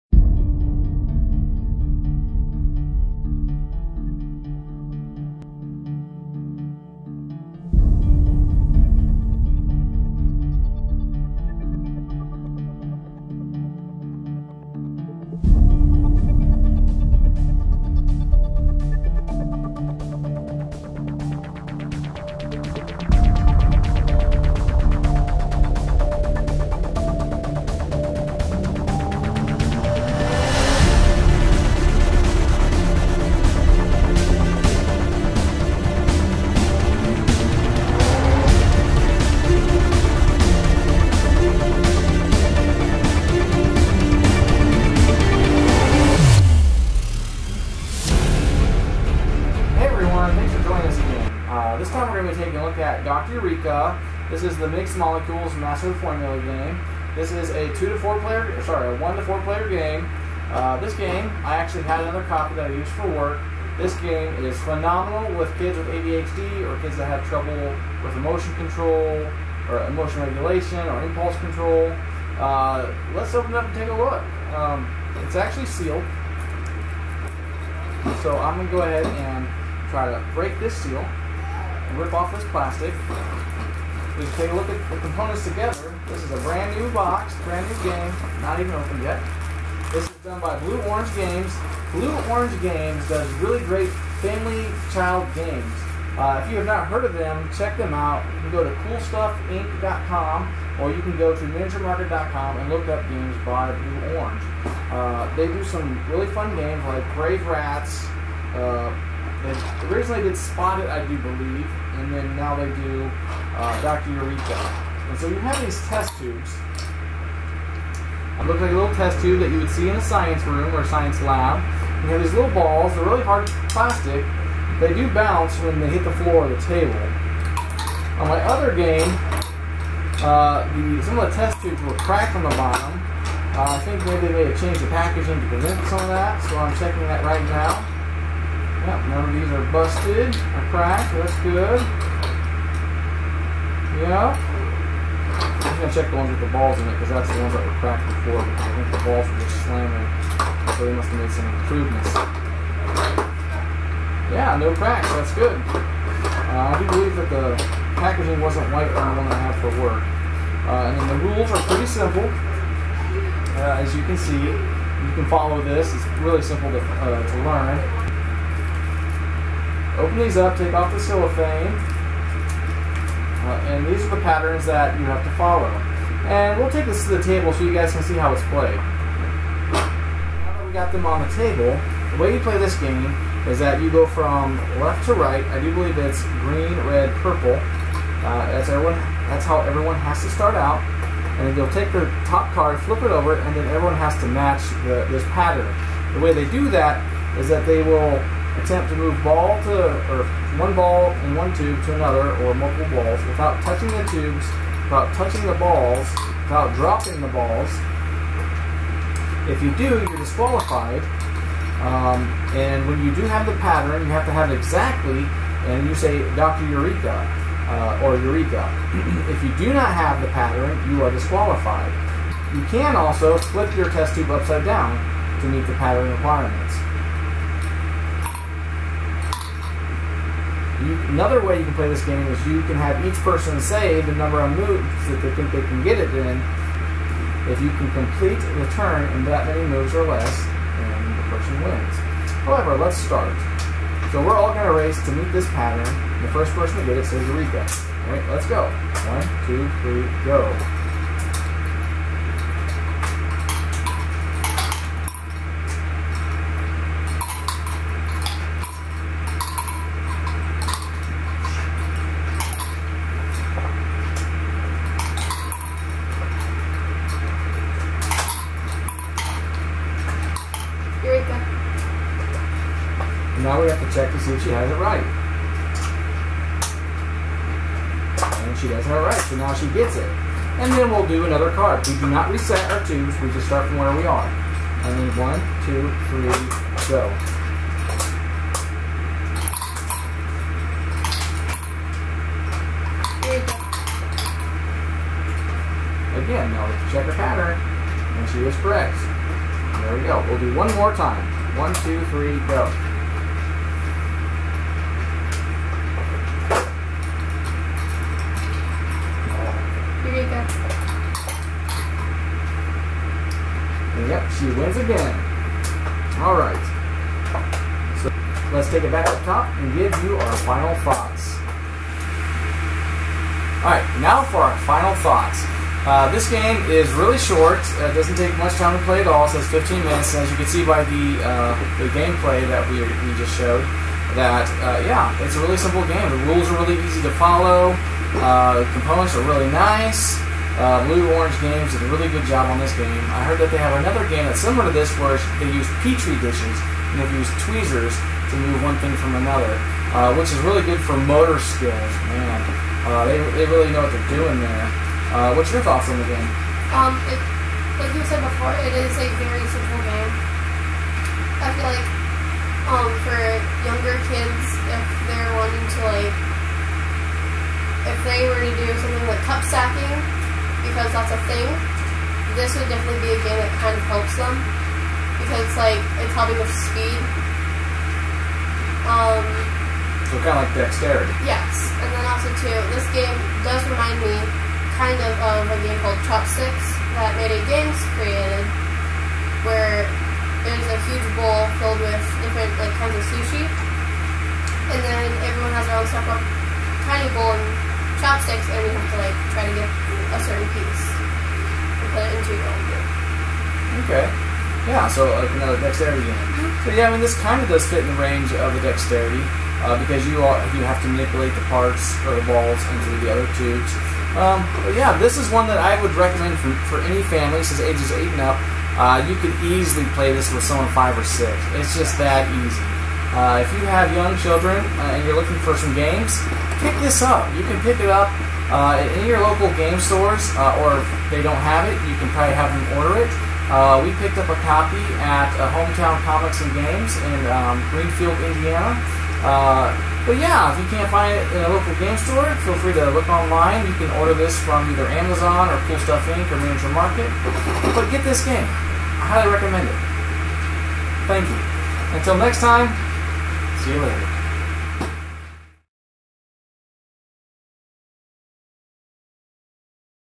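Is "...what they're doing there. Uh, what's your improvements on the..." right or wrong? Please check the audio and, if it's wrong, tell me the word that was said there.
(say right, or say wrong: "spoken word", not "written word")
wrong: "thoughts", not "improvements".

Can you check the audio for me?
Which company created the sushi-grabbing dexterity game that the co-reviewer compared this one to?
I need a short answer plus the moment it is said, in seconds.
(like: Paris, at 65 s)
Made It Games, at 387 s.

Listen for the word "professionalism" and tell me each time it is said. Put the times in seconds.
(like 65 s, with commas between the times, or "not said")
not said.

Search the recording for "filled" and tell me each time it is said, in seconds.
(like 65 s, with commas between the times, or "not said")
391 s.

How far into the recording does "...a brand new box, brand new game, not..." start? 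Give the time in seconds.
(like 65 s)
86 s.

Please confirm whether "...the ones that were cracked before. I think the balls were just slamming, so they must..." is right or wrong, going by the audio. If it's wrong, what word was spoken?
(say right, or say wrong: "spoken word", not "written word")
right.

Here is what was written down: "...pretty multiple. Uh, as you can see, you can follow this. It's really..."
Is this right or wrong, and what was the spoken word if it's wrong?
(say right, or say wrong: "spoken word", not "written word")
wrong: "simple", not "multiple".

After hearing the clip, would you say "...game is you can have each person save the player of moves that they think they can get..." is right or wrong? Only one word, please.
wrong.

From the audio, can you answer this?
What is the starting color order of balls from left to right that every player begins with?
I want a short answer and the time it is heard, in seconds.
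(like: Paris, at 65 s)
green, red, purple, at 186 s.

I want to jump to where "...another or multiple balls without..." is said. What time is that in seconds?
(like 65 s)
201 s.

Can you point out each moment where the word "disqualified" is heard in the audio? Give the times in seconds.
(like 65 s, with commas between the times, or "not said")
210 s, 221 s.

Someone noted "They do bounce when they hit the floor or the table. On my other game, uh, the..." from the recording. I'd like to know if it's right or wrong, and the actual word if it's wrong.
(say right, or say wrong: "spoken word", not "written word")
right.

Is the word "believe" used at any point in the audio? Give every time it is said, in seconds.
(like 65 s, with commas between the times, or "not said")
111 s, 156 s, 185 s.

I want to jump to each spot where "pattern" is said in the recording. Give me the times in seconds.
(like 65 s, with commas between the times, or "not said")
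174 s, 195 s, 213 s, 220 s, 225 s, 245 s, 297 s.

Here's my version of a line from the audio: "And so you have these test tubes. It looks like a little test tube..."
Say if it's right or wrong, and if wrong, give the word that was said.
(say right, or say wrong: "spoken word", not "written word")
right.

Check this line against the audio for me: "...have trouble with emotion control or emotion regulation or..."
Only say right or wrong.
right.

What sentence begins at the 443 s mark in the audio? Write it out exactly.
You can order this from either Amazon or Cool Stuff Inc.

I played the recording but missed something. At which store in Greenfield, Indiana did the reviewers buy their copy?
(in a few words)
Hometown Comics and Games.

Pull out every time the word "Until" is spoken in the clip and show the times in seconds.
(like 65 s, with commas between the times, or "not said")
451 s.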